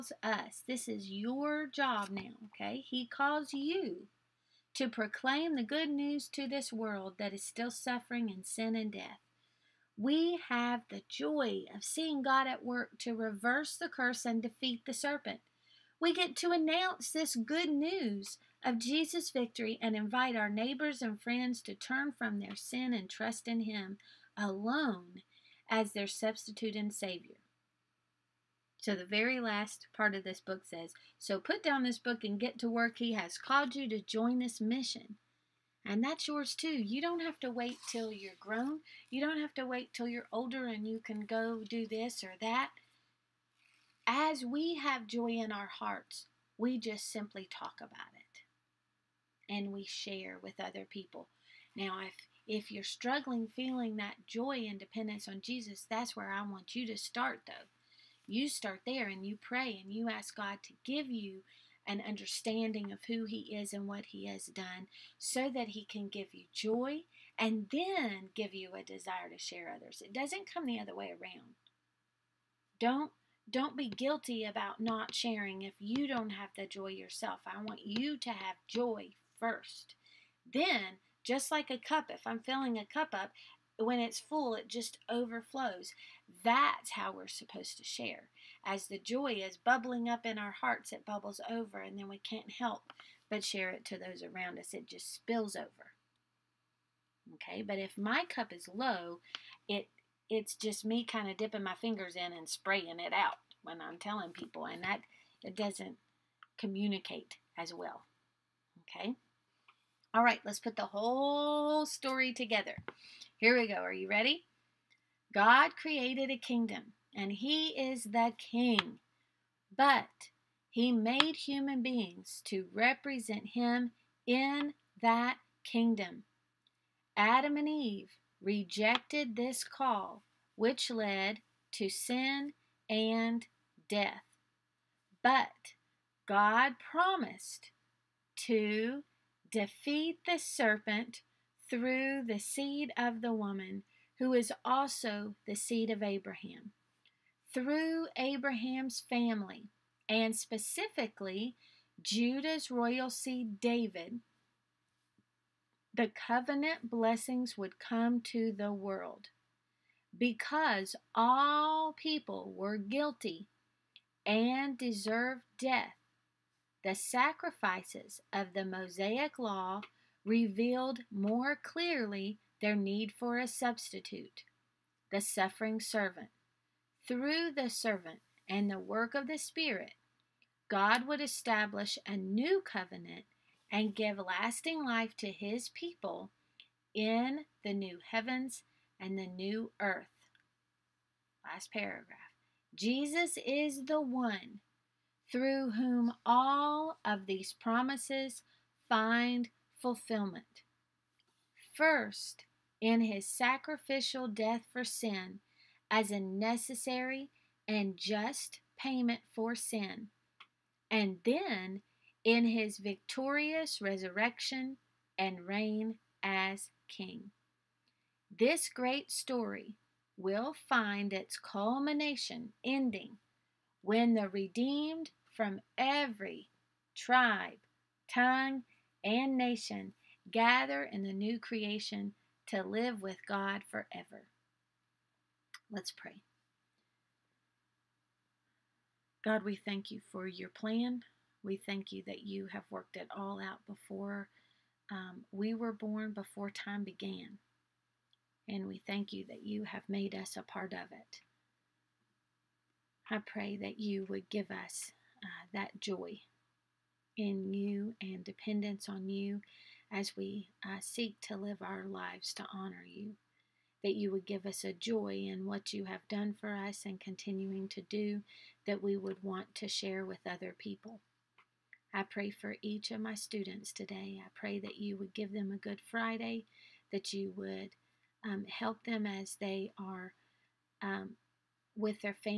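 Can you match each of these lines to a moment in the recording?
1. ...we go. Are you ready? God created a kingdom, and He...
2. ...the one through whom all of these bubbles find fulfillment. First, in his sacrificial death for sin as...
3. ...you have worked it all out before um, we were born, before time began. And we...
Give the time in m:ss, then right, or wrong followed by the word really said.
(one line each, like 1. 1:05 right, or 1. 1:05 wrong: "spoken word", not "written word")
1. 1:53 right
2. 3:13 wrong: "promises", not "bubbles"
3. 4:02 right.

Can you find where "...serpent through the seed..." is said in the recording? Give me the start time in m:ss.
2:20.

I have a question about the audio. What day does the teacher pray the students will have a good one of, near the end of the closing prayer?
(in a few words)
Friday.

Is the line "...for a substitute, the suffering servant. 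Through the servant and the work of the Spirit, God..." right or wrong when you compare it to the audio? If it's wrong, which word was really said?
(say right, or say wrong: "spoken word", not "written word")
right.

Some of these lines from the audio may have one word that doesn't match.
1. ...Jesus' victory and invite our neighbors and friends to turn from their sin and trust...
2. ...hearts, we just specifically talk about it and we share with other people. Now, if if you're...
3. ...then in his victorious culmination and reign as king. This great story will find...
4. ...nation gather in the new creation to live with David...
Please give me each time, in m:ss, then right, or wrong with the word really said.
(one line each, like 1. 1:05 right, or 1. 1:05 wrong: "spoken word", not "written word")
1. 0:18 right
2. 0:45 wrong: "simply", not "specifically"
3. 3:31 wrong: "resurrection", not "culmination"
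4. 3:49 wrong: "God", not "David".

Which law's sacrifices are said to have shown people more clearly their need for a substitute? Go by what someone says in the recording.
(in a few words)
Mosaic law.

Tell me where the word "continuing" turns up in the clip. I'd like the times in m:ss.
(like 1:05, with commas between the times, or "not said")
4:26.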